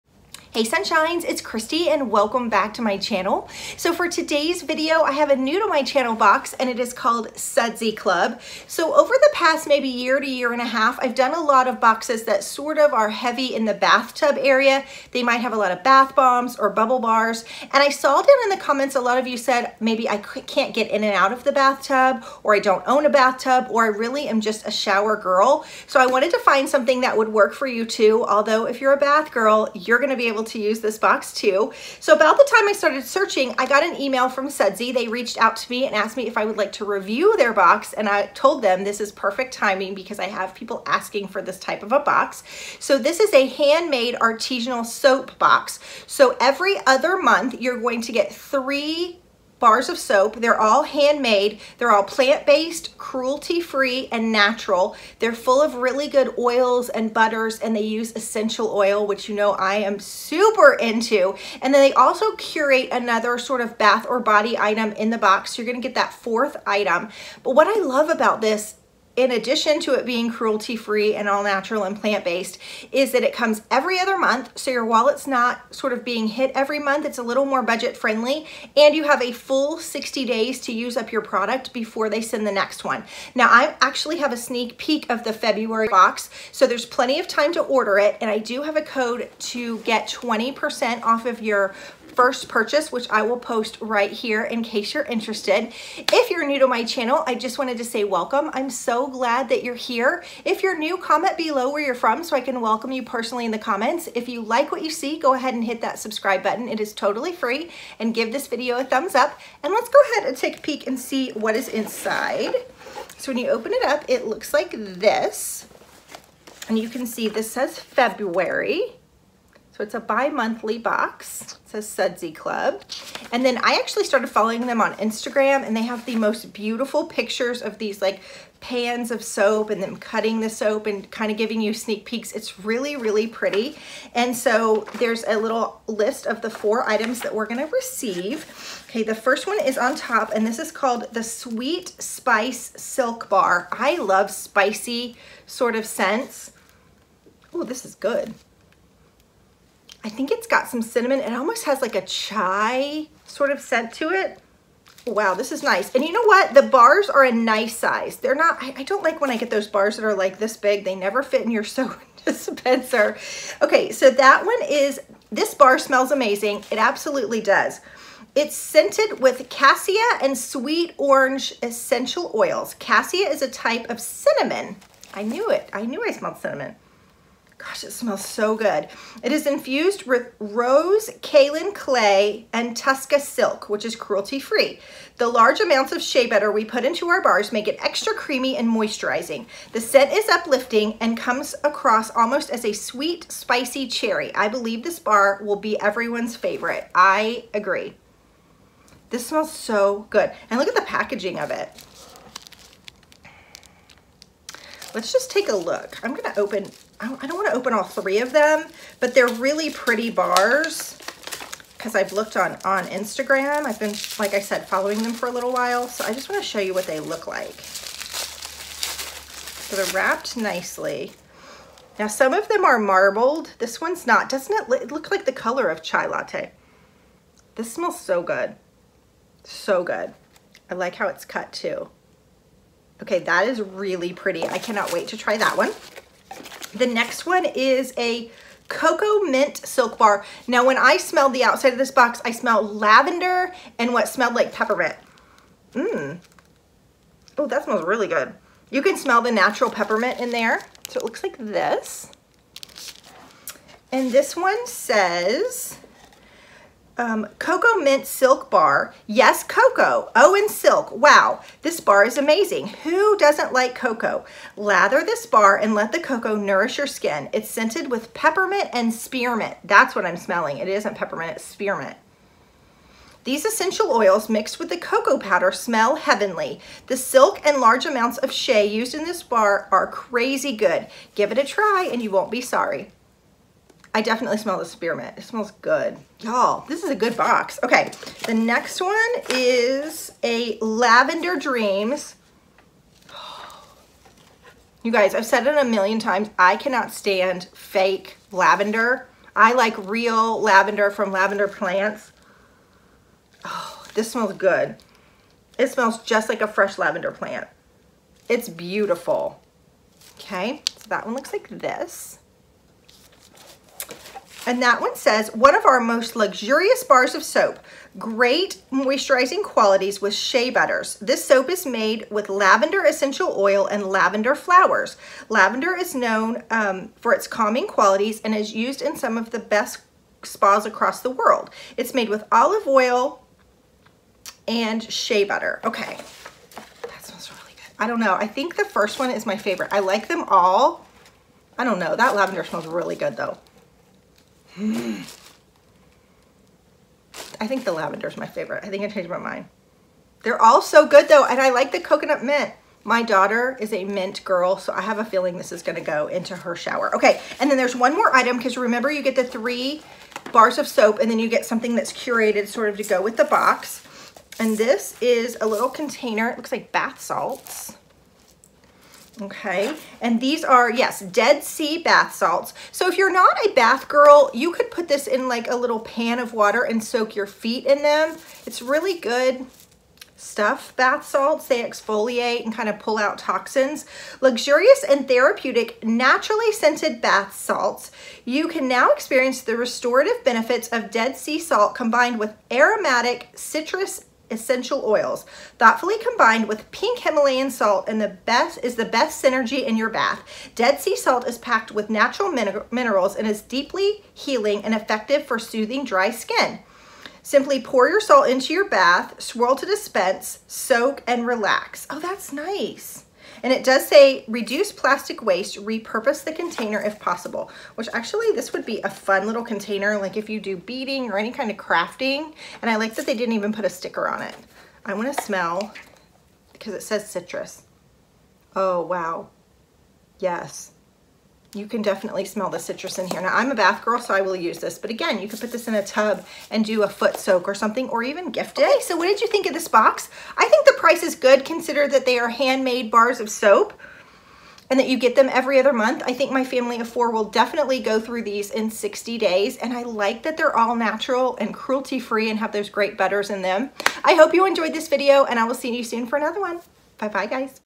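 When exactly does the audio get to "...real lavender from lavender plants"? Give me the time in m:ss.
4:59.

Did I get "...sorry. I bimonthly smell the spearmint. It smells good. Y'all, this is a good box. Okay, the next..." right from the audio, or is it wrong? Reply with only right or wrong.
wrong.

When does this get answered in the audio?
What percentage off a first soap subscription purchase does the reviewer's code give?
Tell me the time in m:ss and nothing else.
1:30.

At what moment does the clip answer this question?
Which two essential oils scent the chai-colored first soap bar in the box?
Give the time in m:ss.
2:49.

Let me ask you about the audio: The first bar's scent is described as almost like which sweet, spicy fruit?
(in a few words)
Cherry.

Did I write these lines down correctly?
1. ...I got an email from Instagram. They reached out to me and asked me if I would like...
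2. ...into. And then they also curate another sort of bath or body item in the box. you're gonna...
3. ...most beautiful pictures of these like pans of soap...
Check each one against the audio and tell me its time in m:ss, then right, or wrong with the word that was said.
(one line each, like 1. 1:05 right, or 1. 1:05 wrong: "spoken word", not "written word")
1. 0:33 wrong: "Sudsy", not "Instagram"
2. 1:00 right
3. 2:06 right.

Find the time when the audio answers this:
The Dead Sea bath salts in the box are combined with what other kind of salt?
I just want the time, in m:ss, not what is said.
6:36.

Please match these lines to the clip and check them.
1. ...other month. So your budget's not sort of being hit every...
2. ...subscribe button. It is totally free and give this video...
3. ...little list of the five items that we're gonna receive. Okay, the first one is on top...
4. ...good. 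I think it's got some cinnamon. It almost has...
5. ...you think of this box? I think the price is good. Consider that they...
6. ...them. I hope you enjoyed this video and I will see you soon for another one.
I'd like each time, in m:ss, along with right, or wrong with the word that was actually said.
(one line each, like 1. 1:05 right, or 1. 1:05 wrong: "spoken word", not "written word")
1. 1:13 wrong: "wallet", not "budget"
2. 1:45 right
3. 2:15 wrong: "four", not "five"
4. 2:27 right
5. 7:19 right
6. 7:33 right.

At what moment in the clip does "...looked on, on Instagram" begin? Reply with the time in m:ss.
3:32.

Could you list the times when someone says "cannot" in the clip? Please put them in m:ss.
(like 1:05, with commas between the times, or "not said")
3:54, 4:56.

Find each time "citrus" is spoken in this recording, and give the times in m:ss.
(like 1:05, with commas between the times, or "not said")
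6:33, 7:07, 7:12.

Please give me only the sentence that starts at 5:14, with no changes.
And that one says, one of our most luxurious bars of soap.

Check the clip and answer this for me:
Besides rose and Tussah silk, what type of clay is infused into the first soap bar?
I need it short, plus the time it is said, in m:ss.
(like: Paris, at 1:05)
Kaolin clay, at 3:01.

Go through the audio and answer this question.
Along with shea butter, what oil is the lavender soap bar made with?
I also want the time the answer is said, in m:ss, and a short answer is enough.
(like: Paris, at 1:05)
Olive oil, at 5:32.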